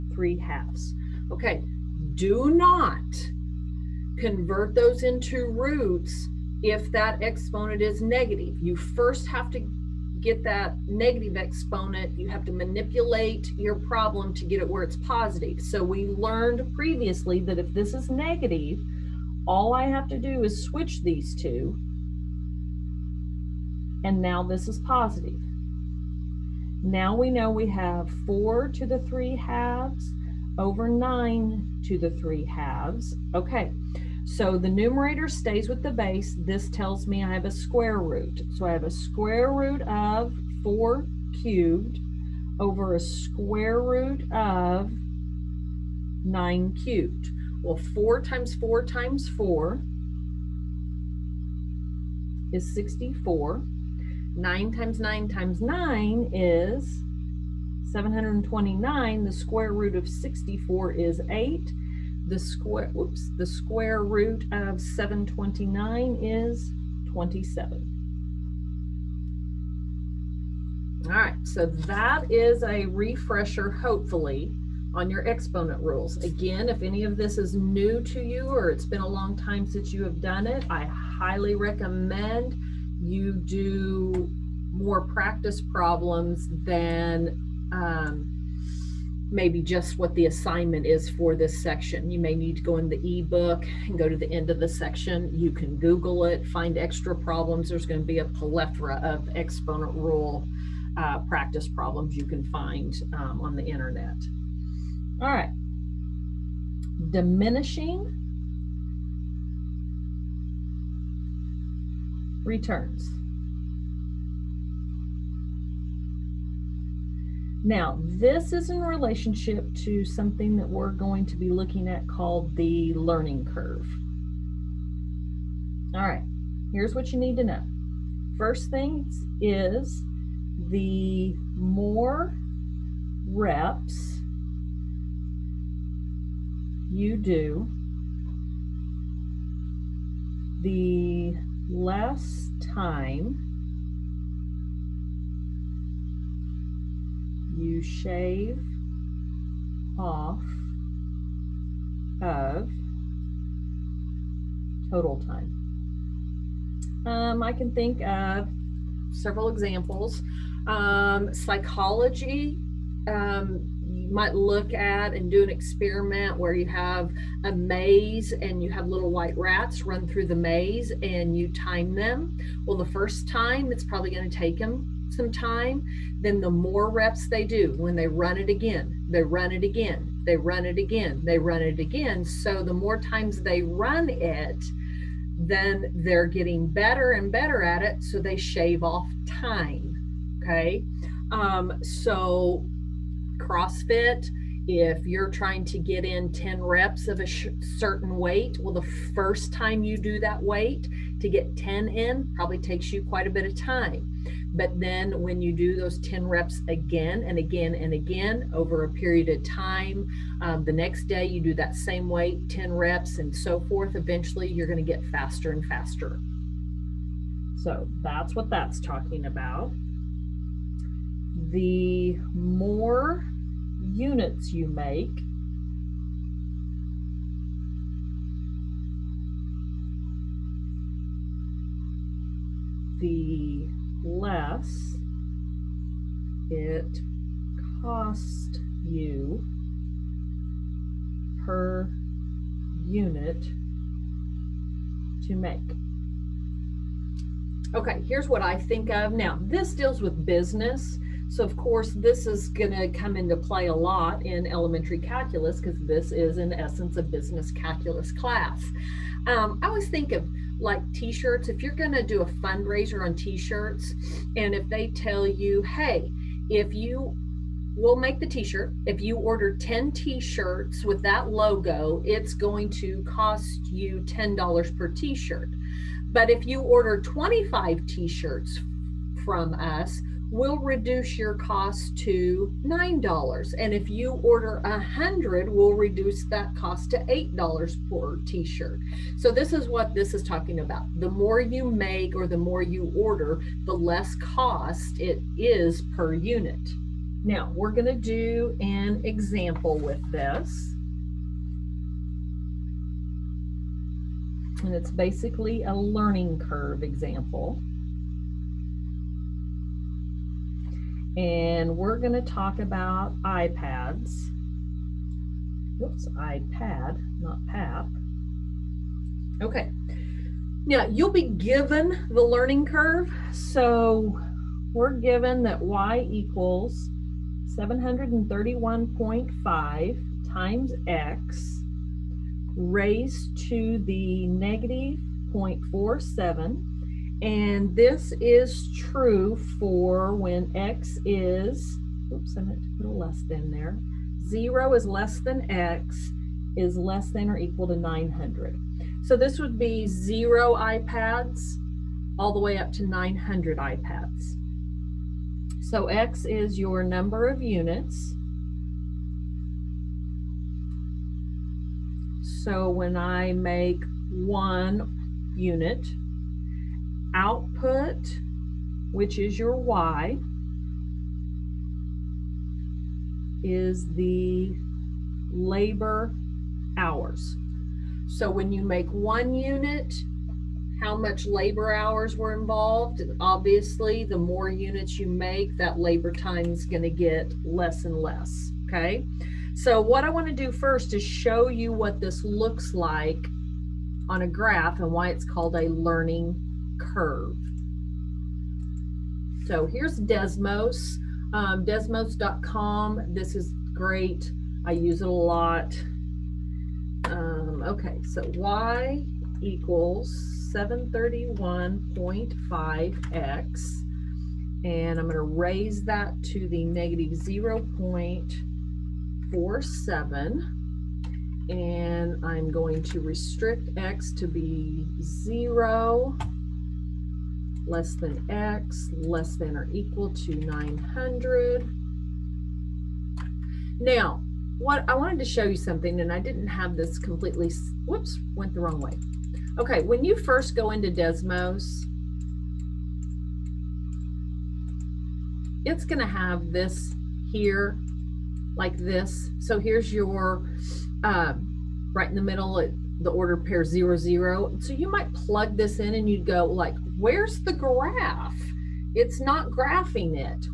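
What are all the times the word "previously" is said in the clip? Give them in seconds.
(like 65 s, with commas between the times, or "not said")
16 s.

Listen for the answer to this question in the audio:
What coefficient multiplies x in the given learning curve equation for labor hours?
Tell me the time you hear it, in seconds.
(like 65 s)
327 s.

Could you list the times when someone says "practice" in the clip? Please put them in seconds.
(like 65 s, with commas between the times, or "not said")
85 s, 101 s.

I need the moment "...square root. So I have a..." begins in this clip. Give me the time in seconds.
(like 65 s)
37 s.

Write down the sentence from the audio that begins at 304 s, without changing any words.
And it's basically a learning curve example.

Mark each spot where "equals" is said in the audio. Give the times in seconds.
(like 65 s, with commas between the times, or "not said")
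326 s, 347 s, 409 s, 429 s.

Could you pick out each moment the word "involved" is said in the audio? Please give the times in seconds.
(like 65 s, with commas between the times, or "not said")
382 s.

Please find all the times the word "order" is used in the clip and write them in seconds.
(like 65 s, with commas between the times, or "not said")
269 s, 276 s, 284 s, 292 s, 453 s.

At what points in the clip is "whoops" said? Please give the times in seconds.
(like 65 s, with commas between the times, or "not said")
62 s, 315 s, 437 s.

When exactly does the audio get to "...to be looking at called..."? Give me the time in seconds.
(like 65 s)
121 s.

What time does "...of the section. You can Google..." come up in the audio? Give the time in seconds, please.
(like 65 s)
94 s.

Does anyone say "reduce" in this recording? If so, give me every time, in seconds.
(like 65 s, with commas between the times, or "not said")
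280 s, 285 s.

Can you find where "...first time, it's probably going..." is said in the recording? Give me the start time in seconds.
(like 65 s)
172 s.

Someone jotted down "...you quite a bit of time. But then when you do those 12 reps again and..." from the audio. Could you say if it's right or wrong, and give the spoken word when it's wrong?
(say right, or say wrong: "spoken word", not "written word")
wrong: "10", not "12".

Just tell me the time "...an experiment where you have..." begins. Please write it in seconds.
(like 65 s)
165 s.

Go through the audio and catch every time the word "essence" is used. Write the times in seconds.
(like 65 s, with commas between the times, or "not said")
256 s.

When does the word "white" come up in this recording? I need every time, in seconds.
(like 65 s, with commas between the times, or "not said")
169 s.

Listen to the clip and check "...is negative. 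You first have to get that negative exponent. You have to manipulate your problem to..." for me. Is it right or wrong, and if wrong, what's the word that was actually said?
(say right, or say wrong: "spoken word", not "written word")
right.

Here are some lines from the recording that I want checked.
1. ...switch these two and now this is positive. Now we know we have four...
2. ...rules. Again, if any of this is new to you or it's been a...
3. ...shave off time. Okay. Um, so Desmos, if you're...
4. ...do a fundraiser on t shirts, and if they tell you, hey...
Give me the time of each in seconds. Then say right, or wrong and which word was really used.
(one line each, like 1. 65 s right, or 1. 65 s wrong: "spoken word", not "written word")
1. 20 s right
2. 75 s right
3. 188 s wrong: "CrossFit", not "Desmos"
4. 262 s right.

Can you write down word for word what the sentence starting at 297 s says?
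Now we're gonna do an example with this.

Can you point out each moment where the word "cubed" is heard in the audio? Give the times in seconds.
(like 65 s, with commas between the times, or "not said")
41 s, 46 s.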